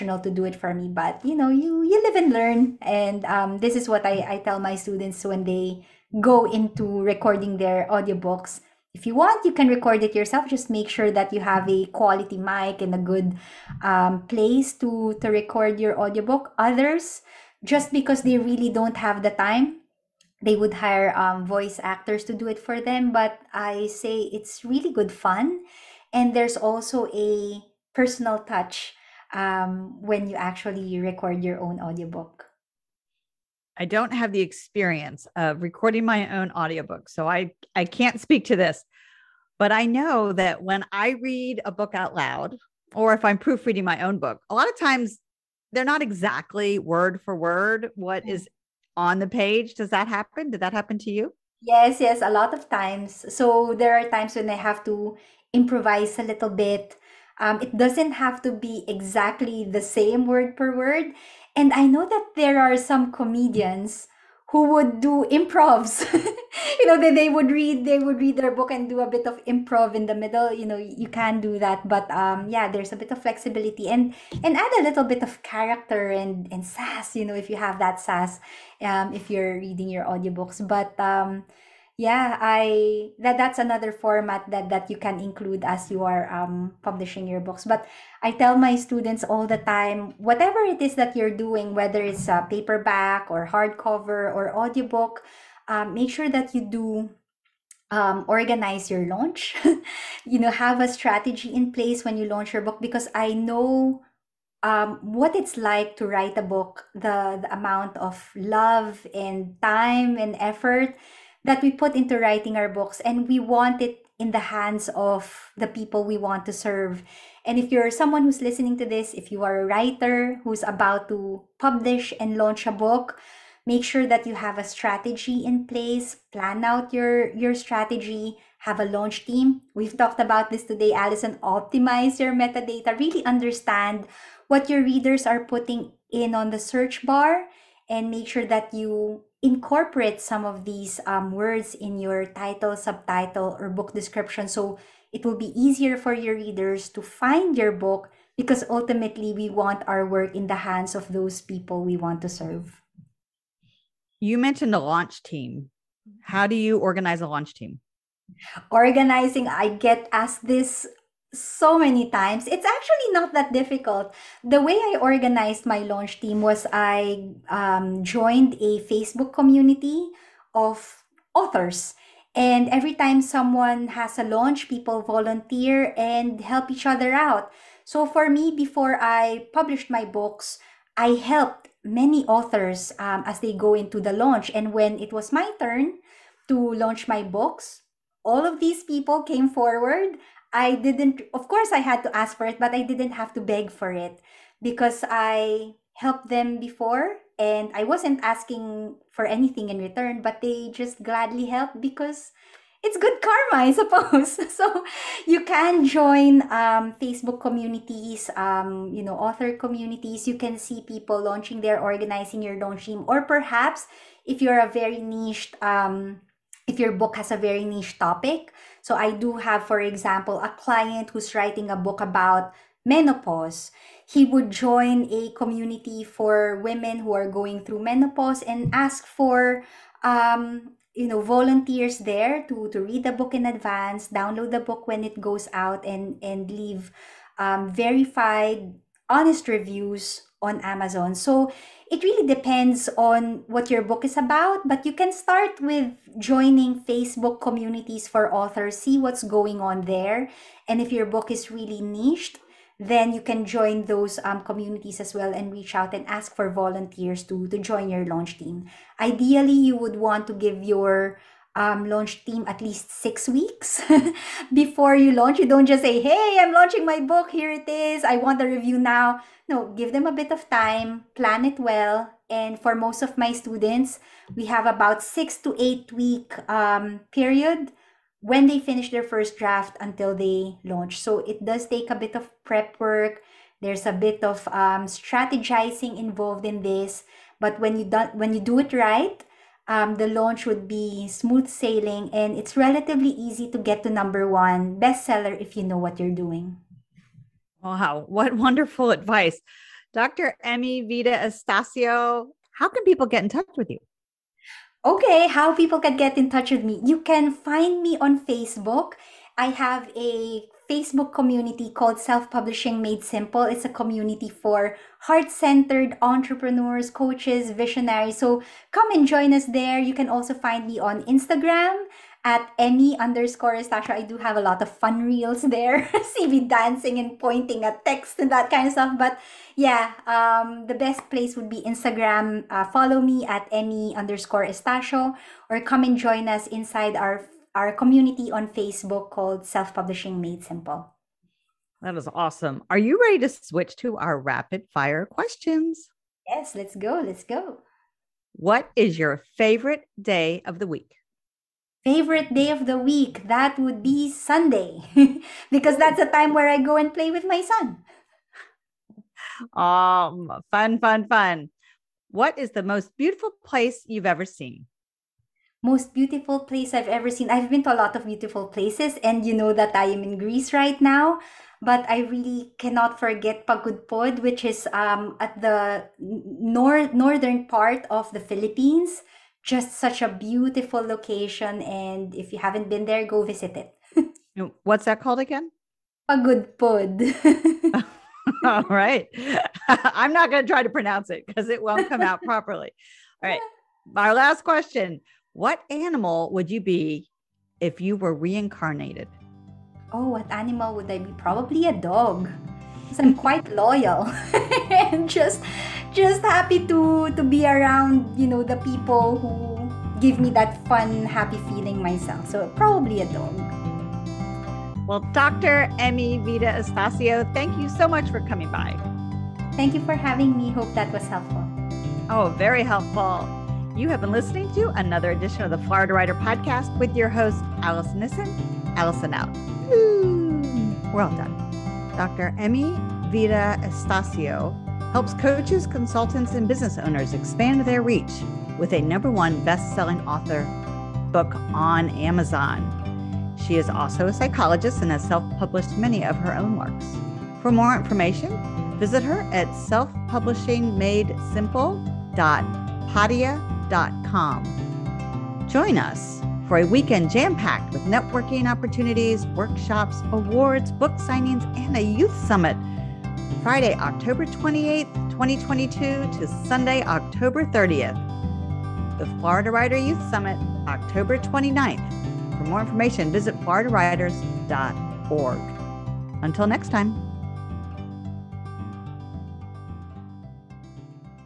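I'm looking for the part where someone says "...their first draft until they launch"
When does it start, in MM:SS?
04:38.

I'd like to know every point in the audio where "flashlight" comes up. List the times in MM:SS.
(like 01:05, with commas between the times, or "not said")
not said.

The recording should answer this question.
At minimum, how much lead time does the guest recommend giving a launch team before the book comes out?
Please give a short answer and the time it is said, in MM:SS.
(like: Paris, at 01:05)
6 weeks, at 04:22.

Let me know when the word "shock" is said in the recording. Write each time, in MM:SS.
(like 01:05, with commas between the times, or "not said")
not said.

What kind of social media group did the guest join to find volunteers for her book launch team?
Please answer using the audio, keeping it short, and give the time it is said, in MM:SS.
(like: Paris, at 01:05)
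Facebook community of authors, at 02:48.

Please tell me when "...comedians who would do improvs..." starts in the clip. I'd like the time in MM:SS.
01:03.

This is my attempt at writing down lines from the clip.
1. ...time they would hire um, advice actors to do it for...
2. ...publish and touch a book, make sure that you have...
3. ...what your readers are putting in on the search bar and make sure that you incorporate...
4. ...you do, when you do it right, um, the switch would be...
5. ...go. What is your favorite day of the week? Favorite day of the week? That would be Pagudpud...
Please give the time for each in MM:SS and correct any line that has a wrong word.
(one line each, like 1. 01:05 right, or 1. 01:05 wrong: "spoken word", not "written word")
1. 00:19 wrong: "voice", not "advice"
2. 02:01 wrong: "launch", not "touch"
3. 02:14 right
4. 04:47 wrong: "launch", not "switch"
5. 05:47 wrong: "Sunday", not "Pagudpud".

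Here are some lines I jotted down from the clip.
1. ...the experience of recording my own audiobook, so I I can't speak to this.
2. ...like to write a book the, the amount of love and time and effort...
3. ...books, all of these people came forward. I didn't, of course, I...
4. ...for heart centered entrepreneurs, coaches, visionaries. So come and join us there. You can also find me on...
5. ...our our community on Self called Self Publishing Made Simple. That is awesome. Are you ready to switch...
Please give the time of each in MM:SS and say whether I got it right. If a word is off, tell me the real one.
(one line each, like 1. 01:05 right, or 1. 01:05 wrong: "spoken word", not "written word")
1. 00:34 right
2. 01:45 right
3. 03:07 right
4. 05:14 right
5. 05:36 wrong: "Facebook", not "Self".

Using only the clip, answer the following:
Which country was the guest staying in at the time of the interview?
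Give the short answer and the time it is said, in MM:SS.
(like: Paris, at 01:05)
Greece, at 06:10.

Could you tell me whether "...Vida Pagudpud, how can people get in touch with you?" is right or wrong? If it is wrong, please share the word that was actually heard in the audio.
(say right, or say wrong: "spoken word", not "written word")
wrong: "Estacio", not "Pagudpud".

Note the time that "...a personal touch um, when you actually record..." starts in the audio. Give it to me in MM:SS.
00:27.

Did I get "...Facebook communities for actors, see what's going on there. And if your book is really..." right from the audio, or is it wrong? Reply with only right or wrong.
wrong.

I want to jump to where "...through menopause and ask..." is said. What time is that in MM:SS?
03:47.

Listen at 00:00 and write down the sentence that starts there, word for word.
But you know, you you live and learn.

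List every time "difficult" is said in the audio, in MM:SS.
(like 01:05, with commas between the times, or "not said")
02:43.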